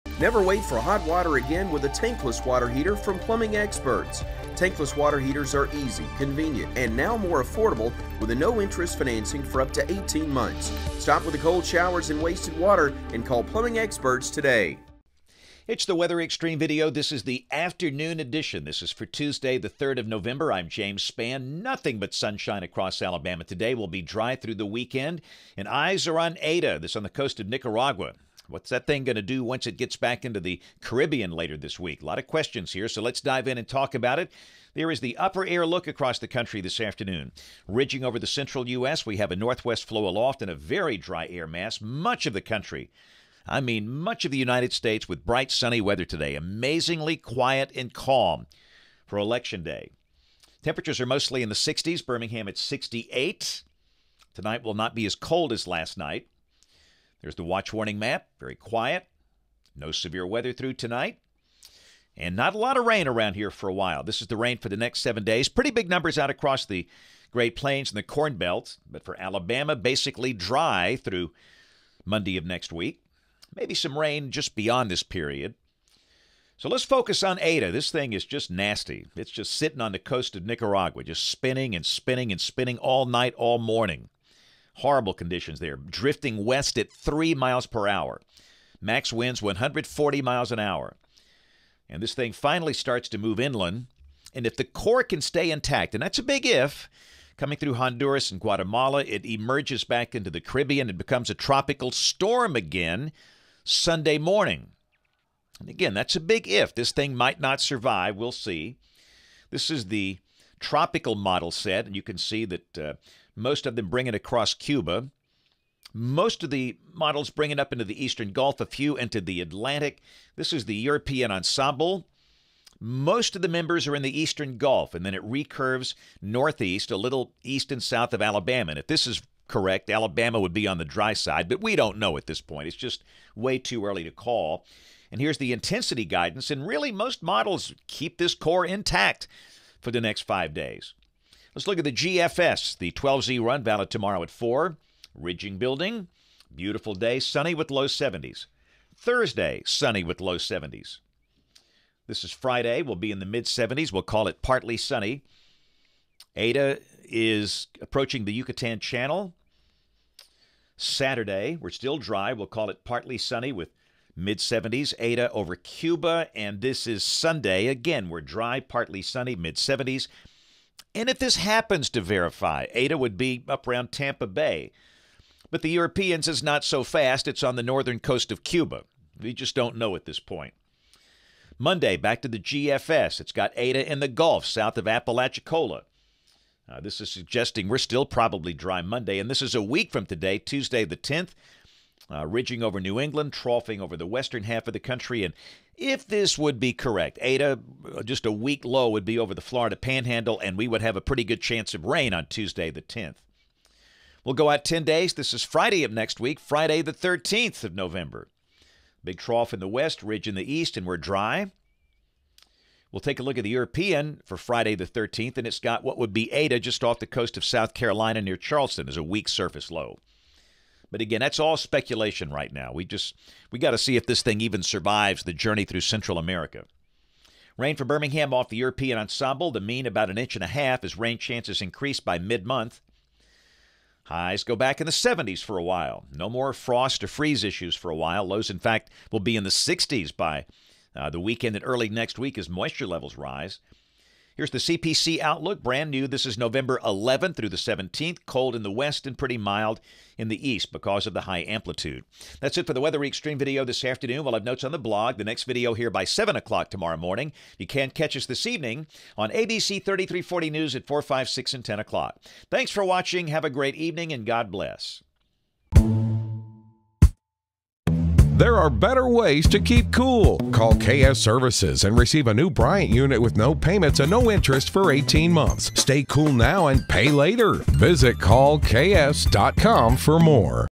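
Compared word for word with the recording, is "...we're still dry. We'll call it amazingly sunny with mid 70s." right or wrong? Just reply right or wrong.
wrong.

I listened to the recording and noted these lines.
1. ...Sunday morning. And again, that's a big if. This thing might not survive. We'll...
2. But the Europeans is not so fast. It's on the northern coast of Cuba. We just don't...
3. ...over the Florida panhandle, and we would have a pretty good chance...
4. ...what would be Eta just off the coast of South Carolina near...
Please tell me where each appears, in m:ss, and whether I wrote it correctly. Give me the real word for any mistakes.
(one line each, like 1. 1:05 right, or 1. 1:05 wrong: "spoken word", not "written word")
1. 1:43 right
2. 2:55 right
3. 3:19 right
4. 3:35 right.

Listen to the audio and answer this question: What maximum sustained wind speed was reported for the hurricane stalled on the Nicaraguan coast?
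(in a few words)
140 miles per hour.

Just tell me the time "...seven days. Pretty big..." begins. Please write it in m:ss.
1:05.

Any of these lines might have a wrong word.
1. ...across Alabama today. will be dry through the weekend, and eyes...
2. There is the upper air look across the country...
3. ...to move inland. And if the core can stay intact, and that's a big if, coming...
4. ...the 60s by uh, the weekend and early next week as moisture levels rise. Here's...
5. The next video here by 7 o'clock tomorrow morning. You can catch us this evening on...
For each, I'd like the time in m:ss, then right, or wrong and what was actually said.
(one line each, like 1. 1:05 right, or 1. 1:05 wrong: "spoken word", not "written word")
1. 0:22 right
2. 0:34 right
3. 1:33 right
4. 3:59 right
5. 4:15 right.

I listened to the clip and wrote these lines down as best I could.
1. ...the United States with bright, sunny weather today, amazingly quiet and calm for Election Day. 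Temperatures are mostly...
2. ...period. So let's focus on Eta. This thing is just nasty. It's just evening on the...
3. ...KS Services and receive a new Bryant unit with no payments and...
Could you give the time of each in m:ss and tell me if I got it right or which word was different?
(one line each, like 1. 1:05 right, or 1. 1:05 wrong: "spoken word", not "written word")
1. 0:44 right
2. 1:15 wrong: "sitting", not "evening"
3. 4:30 right.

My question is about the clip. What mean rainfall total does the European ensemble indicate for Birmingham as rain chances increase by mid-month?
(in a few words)
1.5 inches.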